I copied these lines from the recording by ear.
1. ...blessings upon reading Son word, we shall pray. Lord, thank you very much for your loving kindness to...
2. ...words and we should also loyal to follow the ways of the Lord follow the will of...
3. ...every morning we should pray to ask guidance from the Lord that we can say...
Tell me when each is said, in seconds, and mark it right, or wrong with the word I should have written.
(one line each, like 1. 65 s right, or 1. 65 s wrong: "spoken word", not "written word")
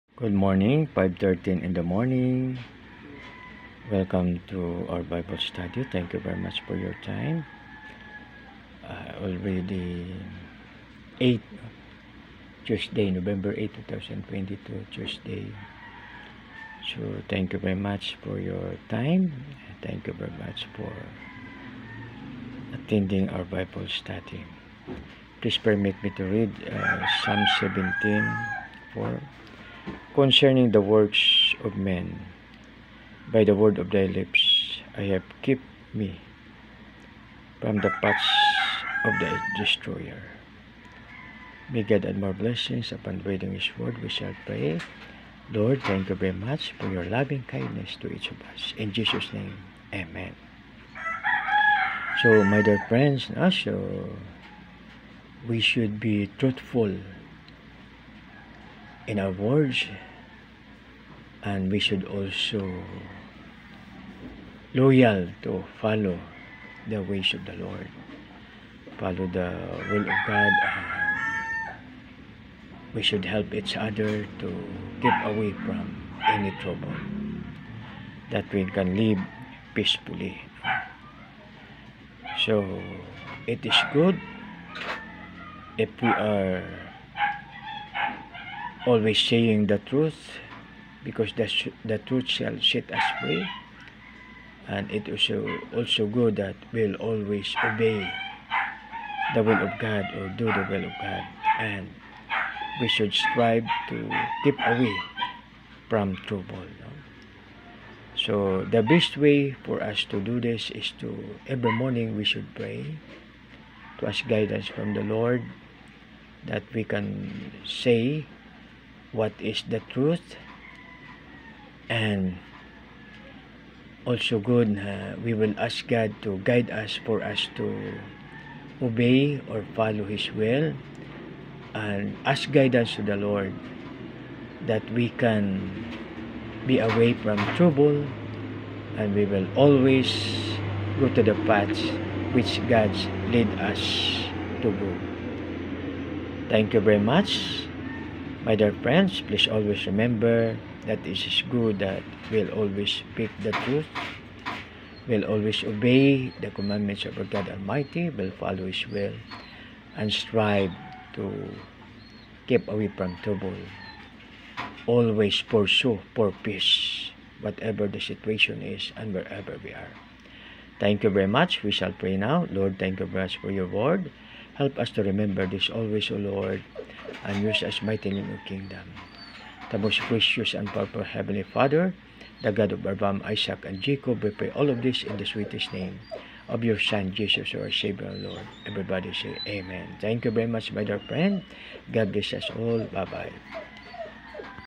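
1. 42 s wrong: "His", not "Son"
2. 59 s right
3. 111 s right.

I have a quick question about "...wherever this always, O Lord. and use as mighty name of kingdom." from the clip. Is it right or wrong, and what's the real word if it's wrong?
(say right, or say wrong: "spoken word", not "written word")
wrong: "remember", not "wherever".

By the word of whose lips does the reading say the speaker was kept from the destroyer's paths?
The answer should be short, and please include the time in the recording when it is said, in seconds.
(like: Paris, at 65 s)
thy lips, at 33 s.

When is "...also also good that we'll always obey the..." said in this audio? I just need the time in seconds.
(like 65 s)
95 s.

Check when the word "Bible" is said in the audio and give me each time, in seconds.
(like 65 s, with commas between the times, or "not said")
5 s, 23 s.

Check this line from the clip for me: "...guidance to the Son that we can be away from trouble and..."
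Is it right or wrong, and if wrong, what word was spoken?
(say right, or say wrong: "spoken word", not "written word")
wrong: "Lord", not "Son".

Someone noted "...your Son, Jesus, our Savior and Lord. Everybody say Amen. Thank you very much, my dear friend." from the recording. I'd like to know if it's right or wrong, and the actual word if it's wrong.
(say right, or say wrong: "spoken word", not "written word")
right.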